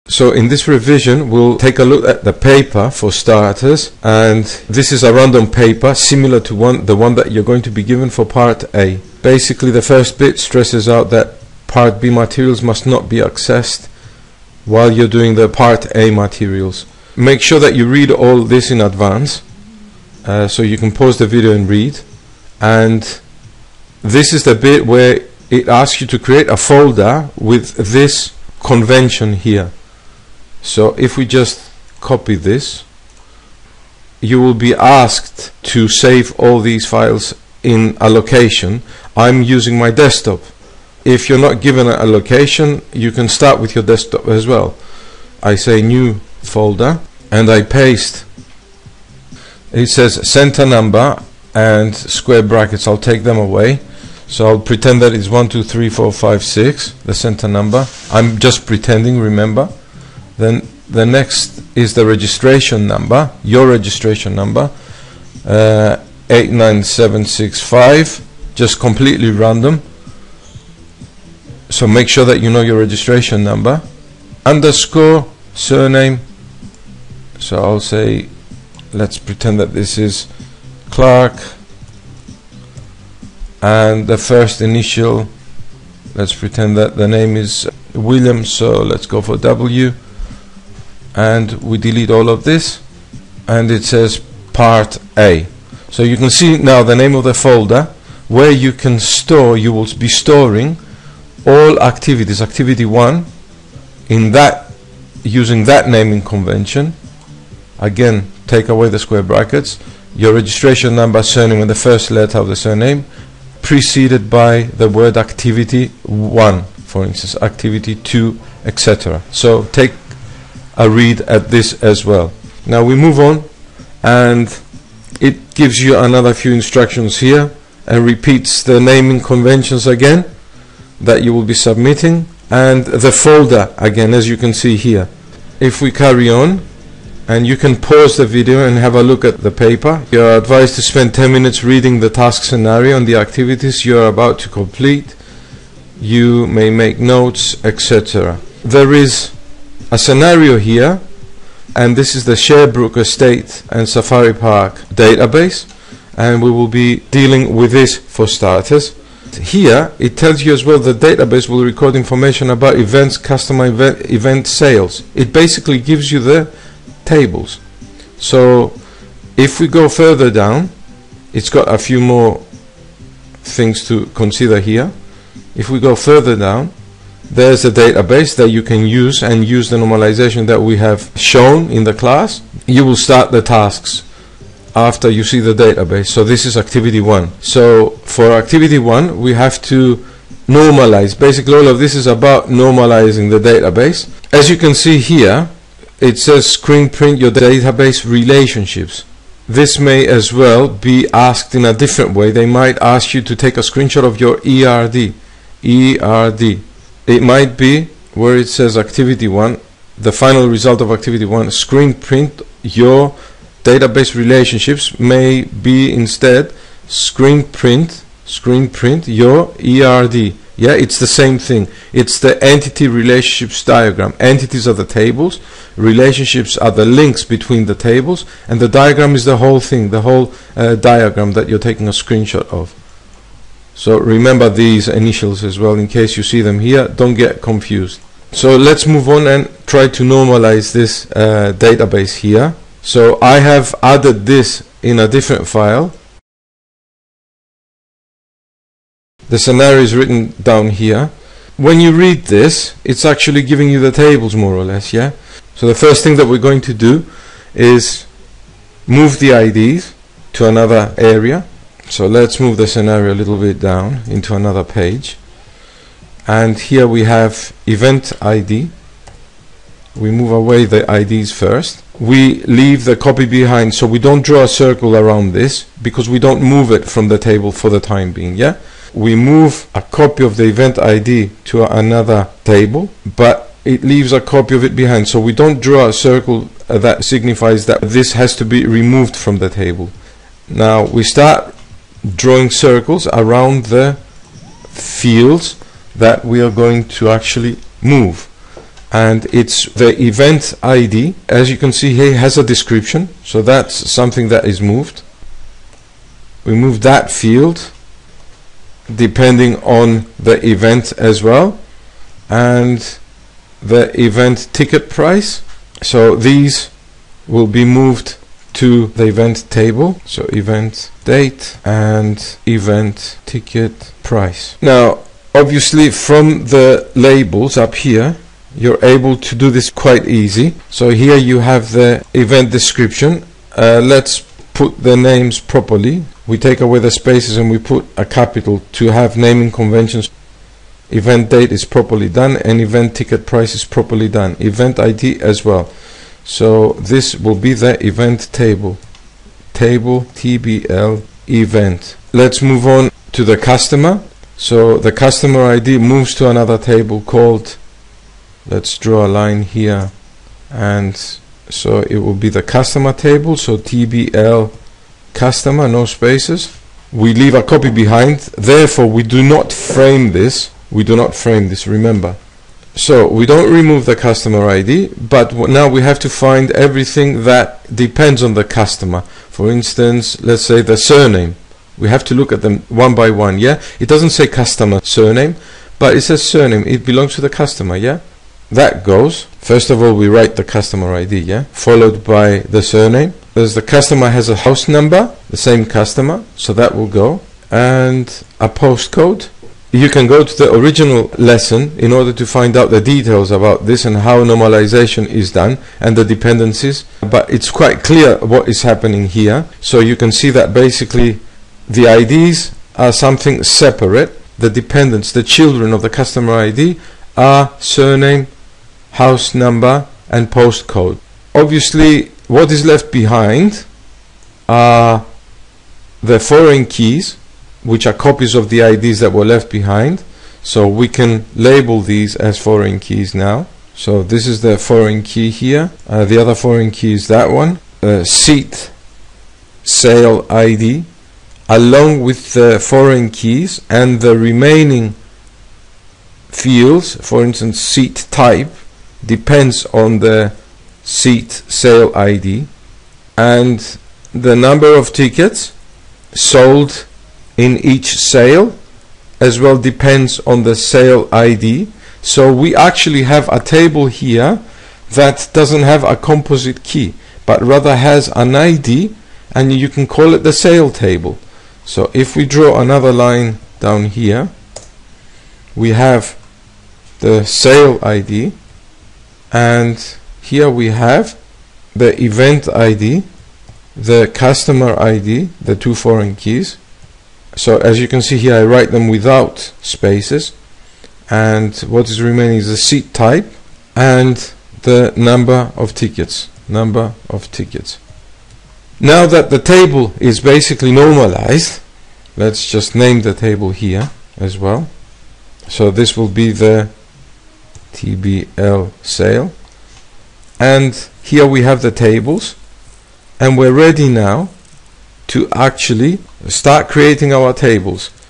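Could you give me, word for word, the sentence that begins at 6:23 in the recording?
It doesn't say customer surname, but it says surname.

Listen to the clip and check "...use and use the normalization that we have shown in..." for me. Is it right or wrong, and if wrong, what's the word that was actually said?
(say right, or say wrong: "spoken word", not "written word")
right.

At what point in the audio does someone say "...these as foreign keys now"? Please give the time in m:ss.
7:11.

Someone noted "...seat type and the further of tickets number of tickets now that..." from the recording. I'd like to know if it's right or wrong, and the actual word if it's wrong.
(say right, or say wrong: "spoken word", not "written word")
wrong: "number", not "further".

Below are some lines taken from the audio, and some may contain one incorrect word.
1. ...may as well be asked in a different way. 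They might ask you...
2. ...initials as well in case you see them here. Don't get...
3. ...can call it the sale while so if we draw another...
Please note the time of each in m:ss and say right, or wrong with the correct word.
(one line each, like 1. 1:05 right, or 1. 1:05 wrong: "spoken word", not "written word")
1. 3:19 right
2. 3:54 right
3. 7:49 wrong: "table", not "while".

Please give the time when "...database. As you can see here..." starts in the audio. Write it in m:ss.
3:13.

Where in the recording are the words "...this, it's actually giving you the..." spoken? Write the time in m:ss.
4:12.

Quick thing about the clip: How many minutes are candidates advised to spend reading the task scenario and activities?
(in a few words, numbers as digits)
10.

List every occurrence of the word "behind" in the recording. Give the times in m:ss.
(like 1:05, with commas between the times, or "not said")
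4:33, 4:44, 6:07, 7:02, 7:09.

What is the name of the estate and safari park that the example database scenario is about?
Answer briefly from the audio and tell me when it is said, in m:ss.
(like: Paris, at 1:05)
Sherbrooke, at 2:32.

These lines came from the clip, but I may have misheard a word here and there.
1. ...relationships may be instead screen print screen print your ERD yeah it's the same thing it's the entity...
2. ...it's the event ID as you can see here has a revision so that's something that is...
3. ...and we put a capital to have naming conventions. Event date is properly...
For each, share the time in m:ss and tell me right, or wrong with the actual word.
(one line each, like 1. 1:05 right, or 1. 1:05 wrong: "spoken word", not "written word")
1. 3:34 right
2. 4:59 wrong: "description", not "revision"
3. 5:37 right.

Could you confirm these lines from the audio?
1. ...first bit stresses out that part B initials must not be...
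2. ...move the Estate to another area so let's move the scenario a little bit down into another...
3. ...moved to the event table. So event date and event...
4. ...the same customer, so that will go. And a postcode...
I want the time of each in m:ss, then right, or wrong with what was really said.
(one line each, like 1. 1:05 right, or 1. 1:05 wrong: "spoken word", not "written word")
1. 0:09 wrong: "materials", not "initials"
2. 4:18 wrong: "IDs", not "Estate"
3. 5:17 right
4. 6:35 right.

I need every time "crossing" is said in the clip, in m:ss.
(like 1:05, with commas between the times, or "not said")
not said.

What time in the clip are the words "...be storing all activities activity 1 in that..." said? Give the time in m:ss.
1:39.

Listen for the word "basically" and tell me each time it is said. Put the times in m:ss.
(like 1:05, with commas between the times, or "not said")
0:09, 2:45, 3:11, 6:50, 8:20.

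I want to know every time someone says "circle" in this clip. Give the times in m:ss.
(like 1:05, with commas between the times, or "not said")
4:34, 4:45, 4:52.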